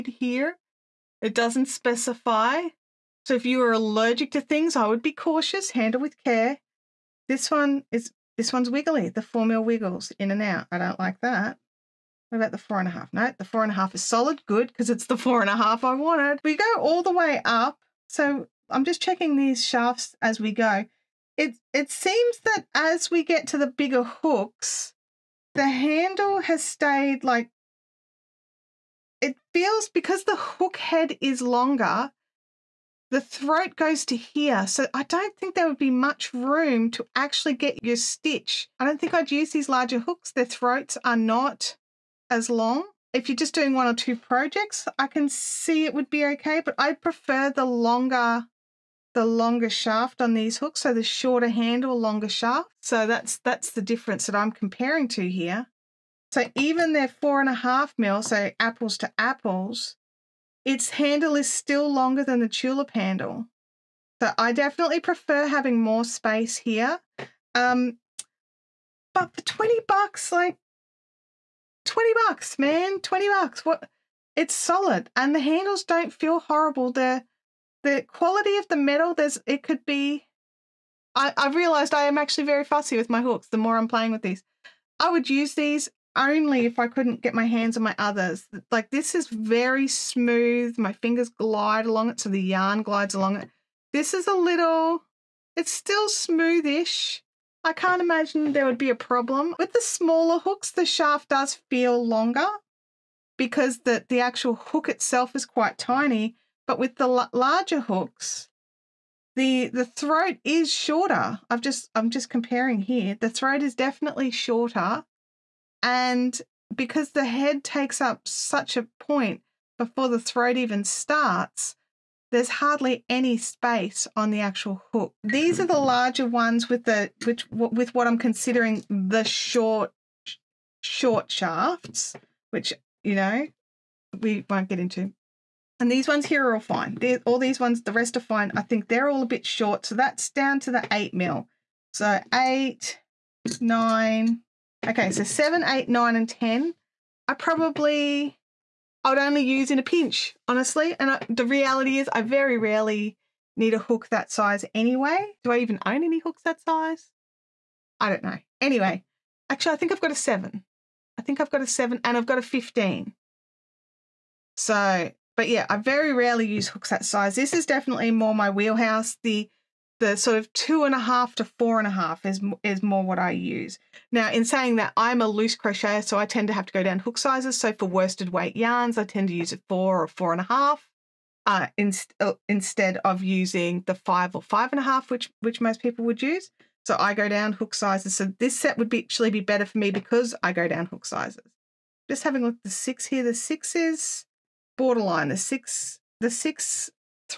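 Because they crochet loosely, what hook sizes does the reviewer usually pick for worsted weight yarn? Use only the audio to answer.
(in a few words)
4 or 4.5.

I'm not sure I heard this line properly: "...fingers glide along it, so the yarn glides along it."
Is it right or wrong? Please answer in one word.
right.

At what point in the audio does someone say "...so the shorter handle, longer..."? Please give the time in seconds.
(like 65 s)
50 s.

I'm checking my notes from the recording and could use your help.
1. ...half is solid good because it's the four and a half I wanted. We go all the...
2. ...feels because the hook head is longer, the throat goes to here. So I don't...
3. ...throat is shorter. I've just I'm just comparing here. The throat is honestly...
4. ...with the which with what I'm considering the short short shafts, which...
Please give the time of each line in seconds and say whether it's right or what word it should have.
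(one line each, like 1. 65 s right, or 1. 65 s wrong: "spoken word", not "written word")
1. 13 s right
2. 29 s right
3. 109 s wrong: "definitely", not "honestly"
4. 126 s right.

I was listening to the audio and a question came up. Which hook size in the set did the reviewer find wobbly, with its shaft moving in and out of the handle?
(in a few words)
4 mm.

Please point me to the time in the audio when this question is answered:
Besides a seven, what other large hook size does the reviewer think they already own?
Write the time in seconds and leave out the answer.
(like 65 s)
162 s.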